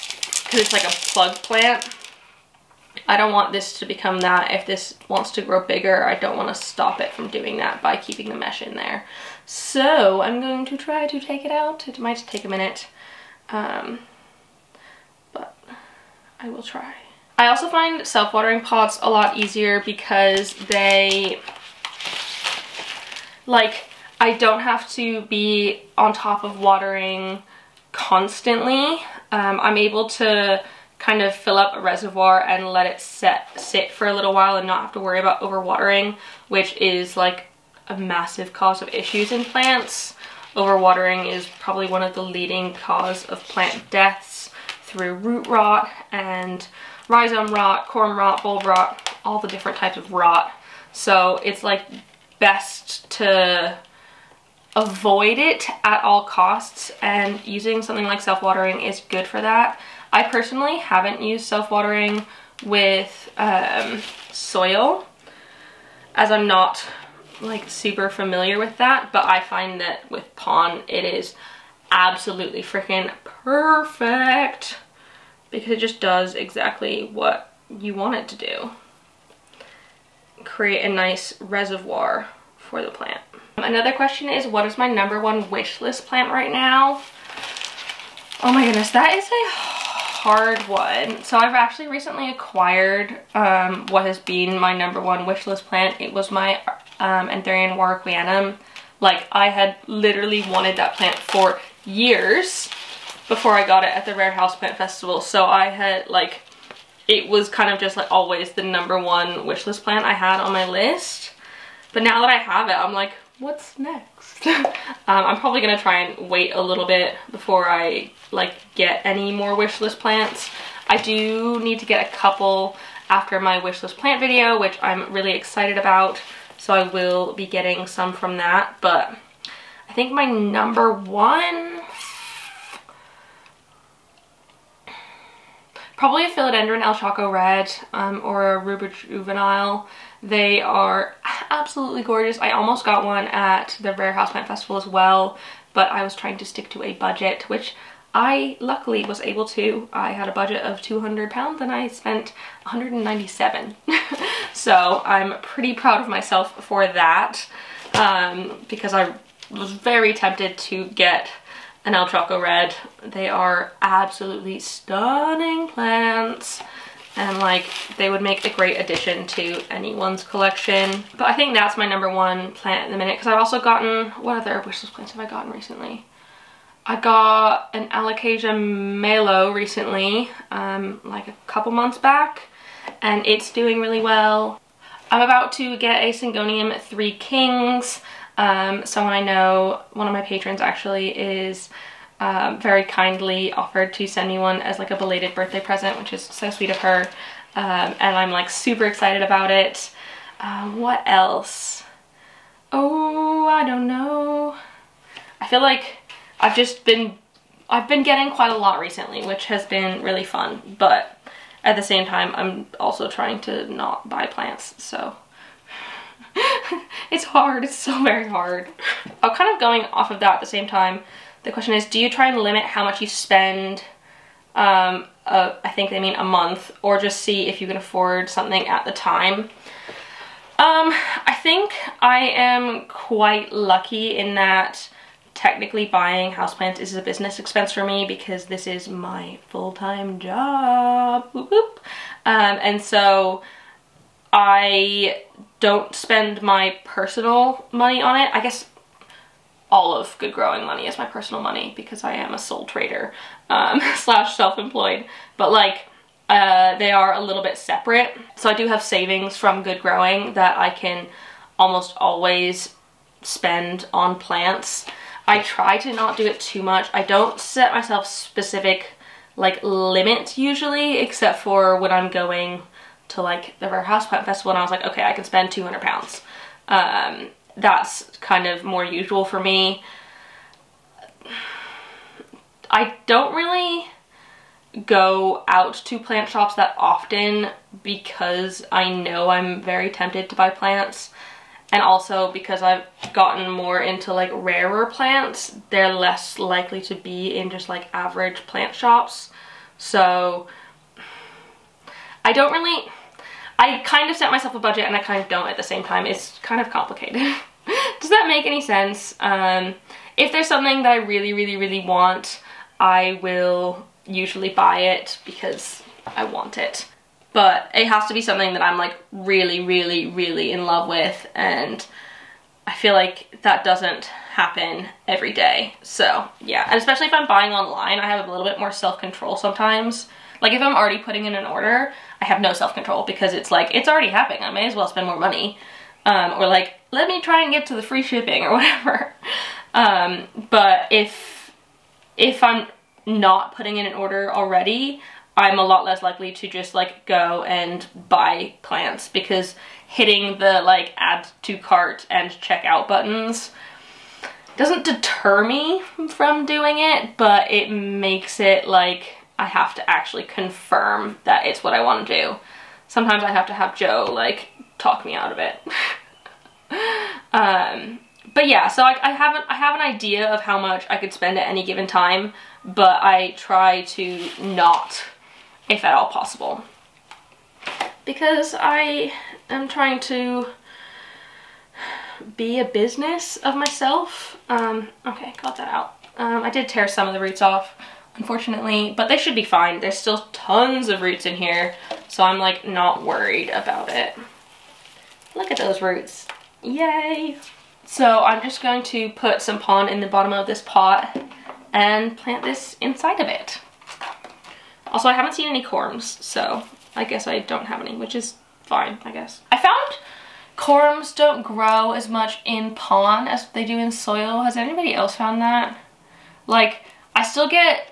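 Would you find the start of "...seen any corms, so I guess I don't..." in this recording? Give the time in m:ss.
6:45.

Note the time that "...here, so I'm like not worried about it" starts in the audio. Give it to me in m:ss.
6:31.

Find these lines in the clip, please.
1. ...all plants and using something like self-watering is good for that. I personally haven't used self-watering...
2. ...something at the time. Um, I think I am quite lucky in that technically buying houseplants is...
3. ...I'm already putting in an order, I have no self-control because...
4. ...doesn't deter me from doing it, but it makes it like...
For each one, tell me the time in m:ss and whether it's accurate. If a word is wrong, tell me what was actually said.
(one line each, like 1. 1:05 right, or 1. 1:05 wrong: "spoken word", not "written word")
1. 0:56 wrong: "costs", not "plants"
2. 3:48 right
3. 5:30 right
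4. 5:54 right.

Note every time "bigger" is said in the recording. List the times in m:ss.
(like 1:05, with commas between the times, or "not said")
0:05.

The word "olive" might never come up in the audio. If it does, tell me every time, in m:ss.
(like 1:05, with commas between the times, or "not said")
not said.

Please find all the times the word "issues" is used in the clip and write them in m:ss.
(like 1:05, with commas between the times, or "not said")
0:38.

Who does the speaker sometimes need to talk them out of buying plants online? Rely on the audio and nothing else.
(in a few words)
Joe.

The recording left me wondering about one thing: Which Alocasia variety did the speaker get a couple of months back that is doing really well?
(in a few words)
Alocasia Malo.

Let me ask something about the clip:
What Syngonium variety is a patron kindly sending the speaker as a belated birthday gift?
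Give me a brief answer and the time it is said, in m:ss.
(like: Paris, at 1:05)
Syngonium Three Kings, at 3:06.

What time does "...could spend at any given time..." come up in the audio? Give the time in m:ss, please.
6:10.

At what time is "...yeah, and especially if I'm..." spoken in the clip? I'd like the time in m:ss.
5:26.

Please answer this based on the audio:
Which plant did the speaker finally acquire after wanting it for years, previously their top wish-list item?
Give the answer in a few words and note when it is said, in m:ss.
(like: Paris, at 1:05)
Anthurium warocqueanum, at 1:37.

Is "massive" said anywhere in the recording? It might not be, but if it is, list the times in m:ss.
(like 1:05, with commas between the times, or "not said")
0:37.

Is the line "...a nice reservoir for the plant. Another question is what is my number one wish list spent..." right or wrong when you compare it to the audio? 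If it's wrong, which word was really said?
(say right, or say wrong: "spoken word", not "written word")
wrong: "plant", not "spent".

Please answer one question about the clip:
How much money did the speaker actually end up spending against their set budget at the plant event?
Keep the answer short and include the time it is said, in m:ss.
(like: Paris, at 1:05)
197 pounds, at 2:32.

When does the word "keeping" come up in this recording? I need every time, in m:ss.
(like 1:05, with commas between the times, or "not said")
0:07.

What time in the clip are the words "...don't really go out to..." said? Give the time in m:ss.
4:43.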